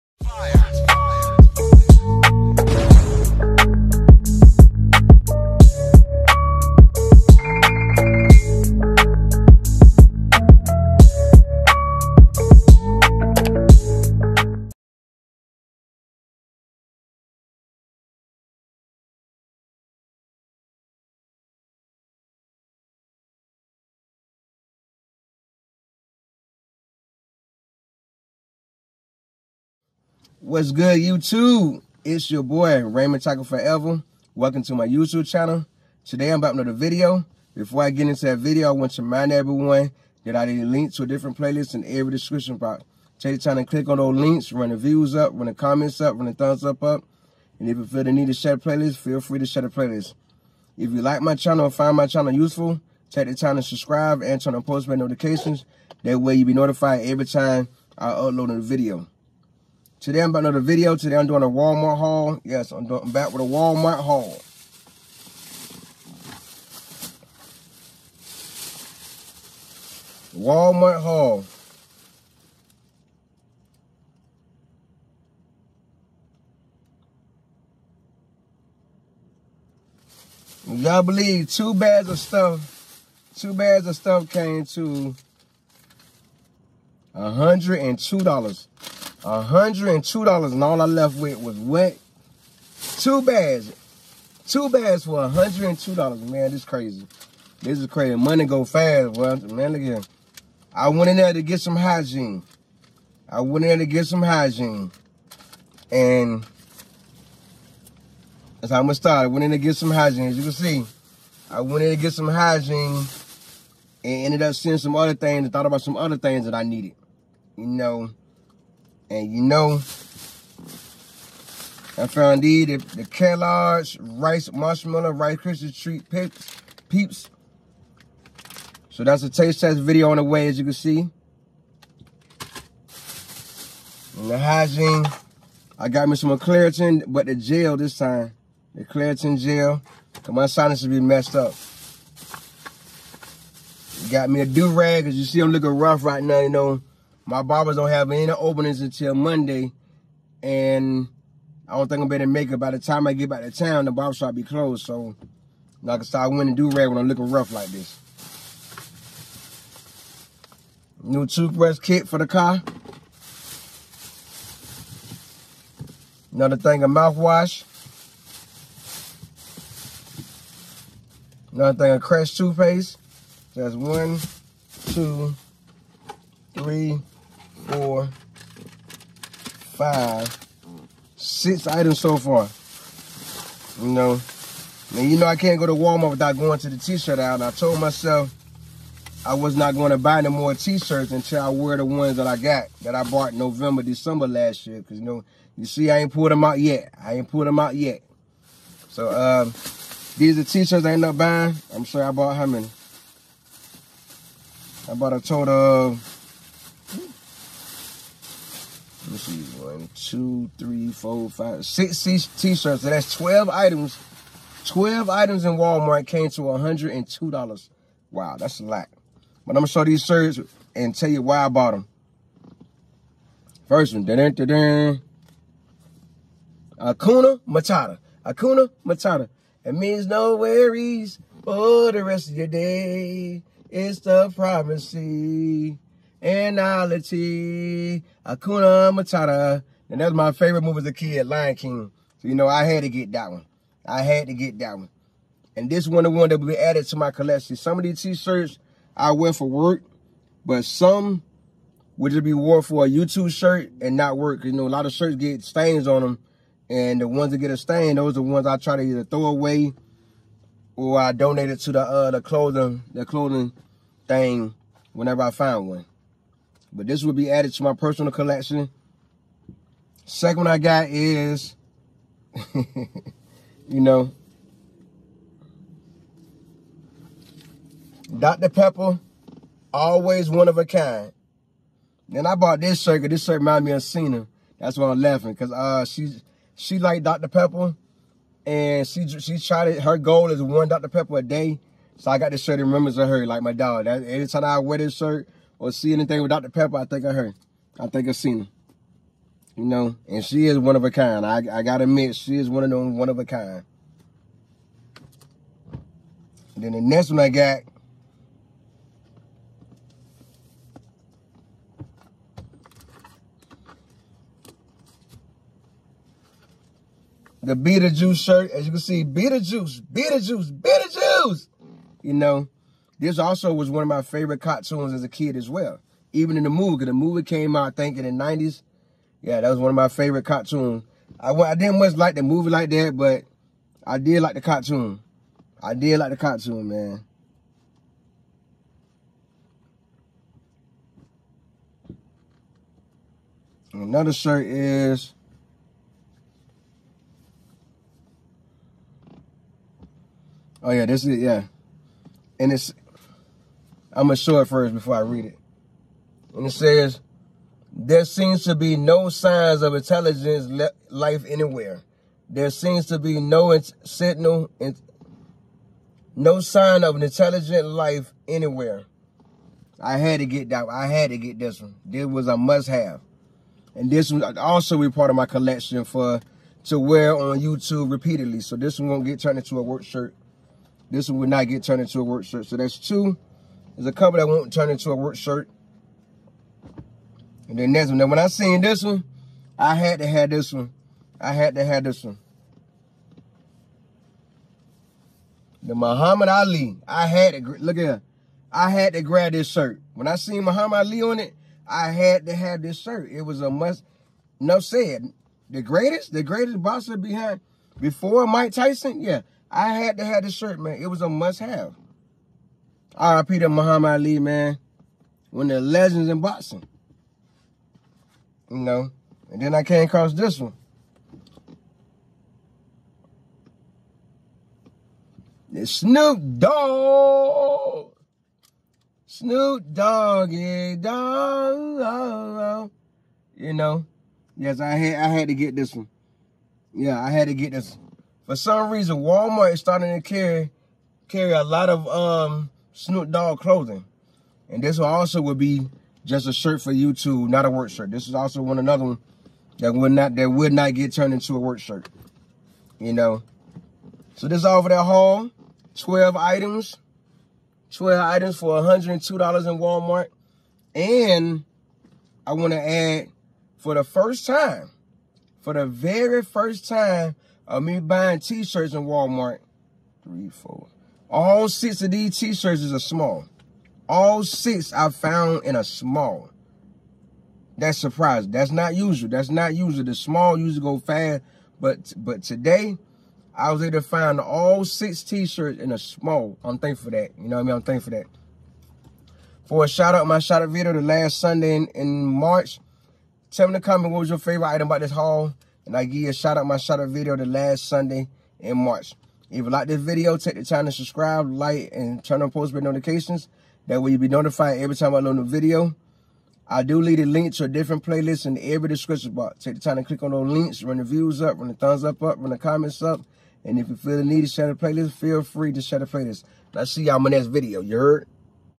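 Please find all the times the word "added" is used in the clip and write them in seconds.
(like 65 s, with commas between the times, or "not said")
246 s, 267 s.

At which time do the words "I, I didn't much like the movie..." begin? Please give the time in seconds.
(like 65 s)
331 s.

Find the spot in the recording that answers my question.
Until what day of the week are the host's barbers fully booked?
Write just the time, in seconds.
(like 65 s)
149 s.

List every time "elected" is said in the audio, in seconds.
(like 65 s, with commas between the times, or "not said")
not said.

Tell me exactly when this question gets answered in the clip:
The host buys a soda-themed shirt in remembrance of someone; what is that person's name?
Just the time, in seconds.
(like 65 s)
283 s.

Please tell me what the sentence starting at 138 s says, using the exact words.
The Claritin gel, because my sinus be messed up.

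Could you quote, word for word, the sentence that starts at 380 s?
This one will not get turned into a work shirt.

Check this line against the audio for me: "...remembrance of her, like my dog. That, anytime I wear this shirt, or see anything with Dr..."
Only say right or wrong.
right.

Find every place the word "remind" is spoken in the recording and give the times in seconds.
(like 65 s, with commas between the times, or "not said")
39 s, 283 s.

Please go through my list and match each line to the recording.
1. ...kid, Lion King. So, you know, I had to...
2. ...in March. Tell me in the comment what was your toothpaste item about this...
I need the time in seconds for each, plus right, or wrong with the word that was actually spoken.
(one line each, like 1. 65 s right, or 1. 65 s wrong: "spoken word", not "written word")
1. 240 s right
2. 491 s wrong: "favorite", not "toothpaste".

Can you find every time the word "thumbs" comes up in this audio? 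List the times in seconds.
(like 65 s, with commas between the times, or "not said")
46 s, 511 s.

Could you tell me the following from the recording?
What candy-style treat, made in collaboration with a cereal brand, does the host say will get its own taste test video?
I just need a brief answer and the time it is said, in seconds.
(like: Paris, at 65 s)
Rice Krispie Treat Peeps, at 125 s.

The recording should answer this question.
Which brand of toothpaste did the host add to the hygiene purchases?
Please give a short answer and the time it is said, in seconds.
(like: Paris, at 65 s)
Crest, at 171 s.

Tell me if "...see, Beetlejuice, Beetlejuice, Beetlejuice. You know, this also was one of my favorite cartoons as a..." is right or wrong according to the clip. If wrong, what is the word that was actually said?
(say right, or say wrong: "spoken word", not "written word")
right.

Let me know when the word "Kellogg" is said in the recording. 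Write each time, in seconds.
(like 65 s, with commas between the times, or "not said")
123 s.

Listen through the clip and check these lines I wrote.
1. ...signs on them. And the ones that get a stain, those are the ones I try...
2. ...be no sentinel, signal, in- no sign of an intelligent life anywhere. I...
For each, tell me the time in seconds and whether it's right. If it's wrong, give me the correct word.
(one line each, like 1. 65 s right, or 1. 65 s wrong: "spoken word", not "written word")
1. 255 s wrong: "stains", not "signs"
2. 362 s right.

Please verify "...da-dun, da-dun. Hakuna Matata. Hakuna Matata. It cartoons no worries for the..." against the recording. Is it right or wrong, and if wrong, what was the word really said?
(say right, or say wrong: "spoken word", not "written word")
wrong: "means", not "cartoons".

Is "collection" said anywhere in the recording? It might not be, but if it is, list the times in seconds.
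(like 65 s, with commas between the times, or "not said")
247 s, 268 s, 375 s.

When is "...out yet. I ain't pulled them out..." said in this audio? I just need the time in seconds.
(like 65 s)
196 s.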